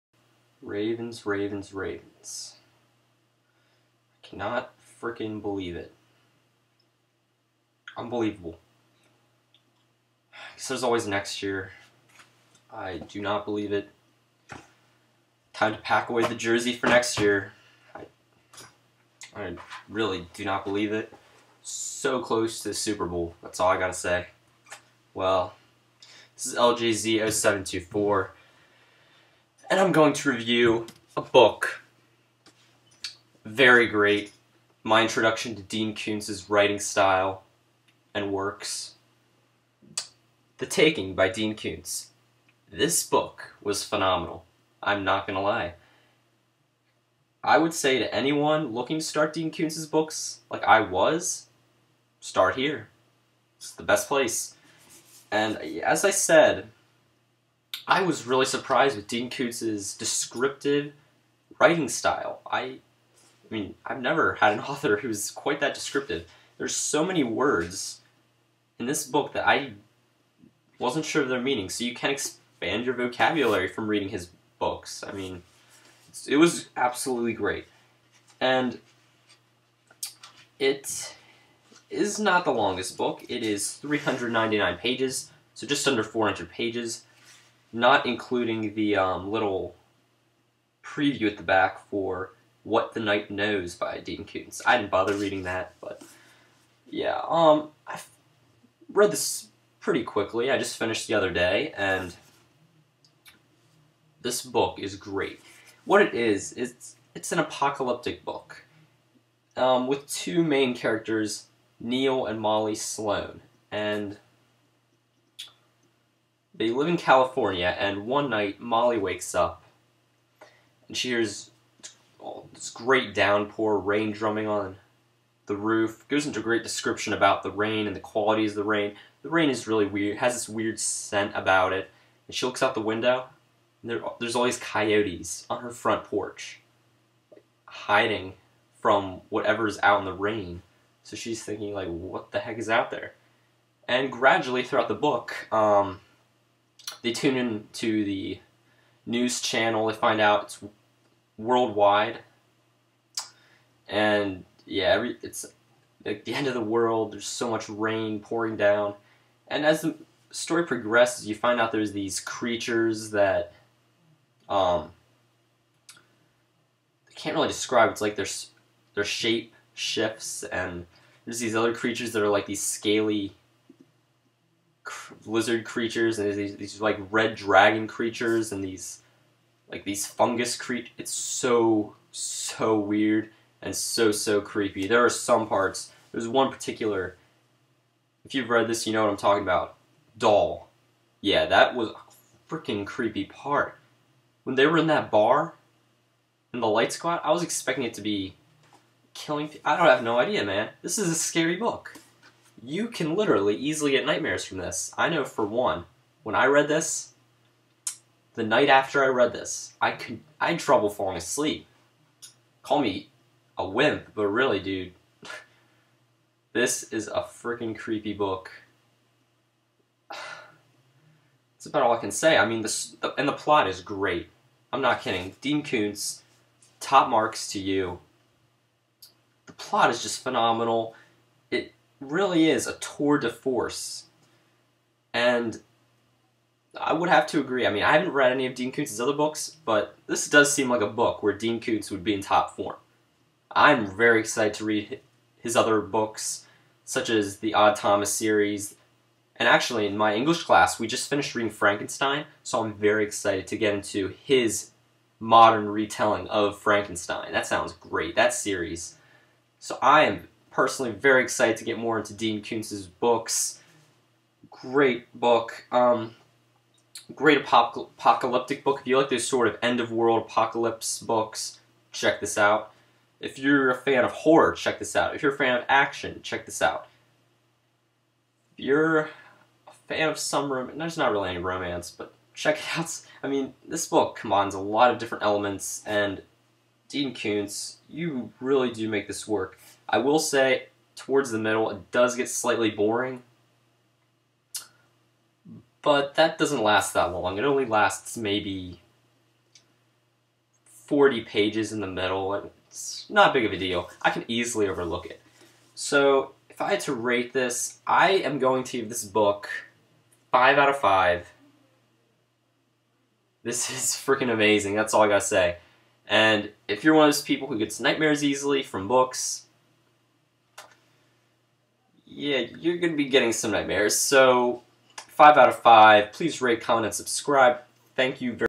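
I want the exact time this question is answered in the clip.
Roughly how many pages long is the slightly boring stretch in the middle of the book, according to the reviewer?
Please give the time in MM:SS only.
05:00.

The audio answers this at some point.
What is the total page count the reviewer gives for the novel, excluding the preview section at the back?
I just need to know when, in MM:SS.
01:23.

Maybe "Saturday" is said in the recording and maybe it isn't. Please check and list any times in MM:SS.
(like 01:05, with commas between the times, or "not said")
not said.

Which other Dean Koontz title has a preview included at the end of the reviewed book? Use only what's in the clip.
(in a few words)
What the Night Knows.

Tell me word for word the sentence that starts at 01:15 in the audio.
I mean, it was absolutely great.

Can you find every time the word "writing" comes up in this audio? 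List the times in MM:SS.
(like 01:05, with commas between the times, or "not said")
00:36, 01:01.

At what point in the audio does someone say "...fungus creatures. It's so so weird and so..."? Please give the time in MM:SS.
03:00.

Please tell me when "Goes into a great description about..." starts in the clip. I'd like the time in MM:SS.
02:06.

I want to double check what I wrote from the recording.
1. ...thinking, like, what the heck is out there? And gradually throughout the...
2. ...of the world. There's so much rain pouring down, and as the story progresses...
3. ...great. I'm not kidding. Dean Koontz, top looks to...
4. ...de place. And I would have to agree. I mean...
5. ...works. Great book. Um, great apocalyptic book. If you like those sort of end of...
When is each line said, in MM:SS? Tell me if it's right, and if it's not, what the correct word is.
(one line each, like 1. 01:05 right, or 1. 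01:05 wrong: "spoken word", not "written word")
1. 02:21 right
2. 02:36 right
3. 03:43 wrong: "marks", not "looks"
4. 03:53 wrong: "force", not "place"
5. 04:22 wrong: "books", not "works".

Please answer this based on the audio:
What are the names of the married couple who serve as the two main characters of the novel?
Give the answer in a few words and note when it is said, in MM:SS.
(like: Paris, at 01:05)
Neil and Molly Sloan, at 01:51.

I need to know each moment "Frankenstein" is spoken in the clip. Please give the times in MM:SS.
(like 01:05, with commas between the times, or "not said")
04:11, 04:16.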